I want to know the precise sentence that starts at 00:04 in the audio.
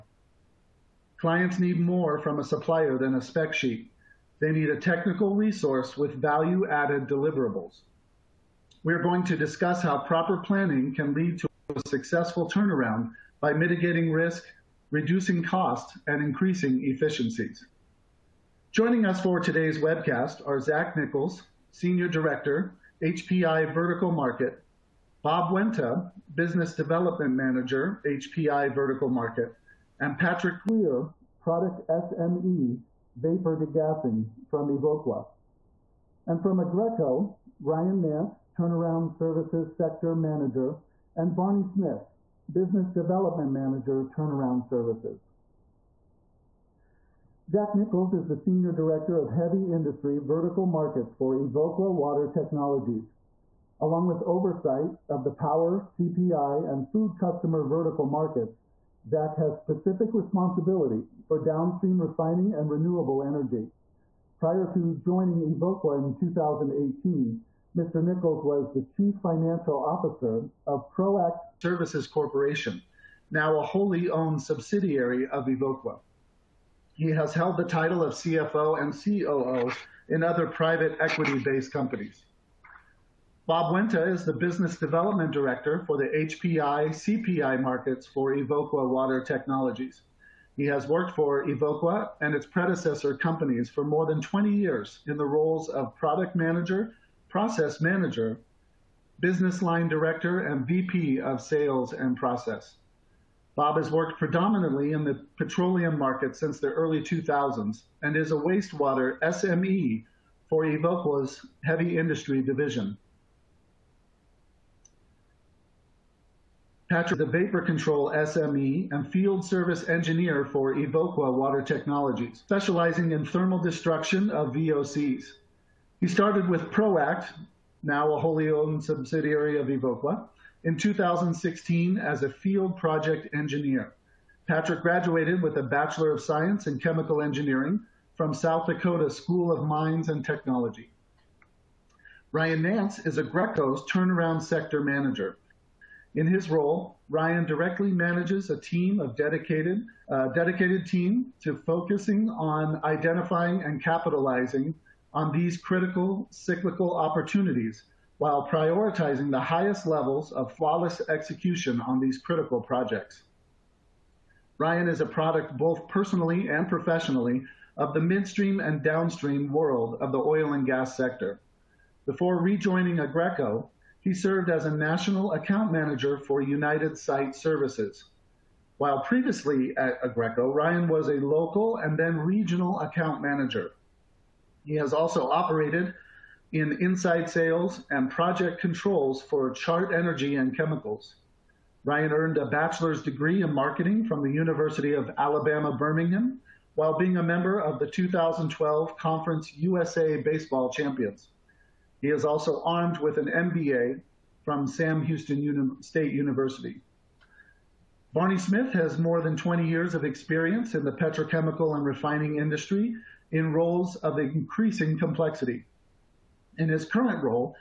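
They need a technical resource with value-added deliverables.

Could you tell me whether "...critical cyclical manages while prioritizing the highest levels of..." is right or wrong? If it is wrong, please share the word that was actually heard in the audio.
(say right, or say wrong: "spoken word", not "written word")
wrong: "opportunities", not "manages".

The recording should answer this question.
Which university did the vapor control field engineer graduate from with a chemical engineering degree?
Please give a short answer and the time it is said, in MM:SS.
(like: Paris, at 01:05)
South Dakota School of Mines and Technology, at 02:18.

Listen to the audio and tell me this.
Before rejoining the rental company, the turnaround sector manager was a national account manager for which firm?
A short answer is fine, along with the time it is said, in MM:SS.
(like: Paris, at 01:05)
United Site Services, at 02:56.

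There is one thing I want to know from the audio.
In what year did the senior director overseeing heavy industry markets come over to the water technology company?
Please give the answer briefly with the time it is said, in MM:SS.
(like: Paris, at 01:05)
2018, at 01:06.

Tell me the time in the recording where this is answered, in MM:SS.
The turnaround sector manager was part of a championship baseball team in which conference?
03:18.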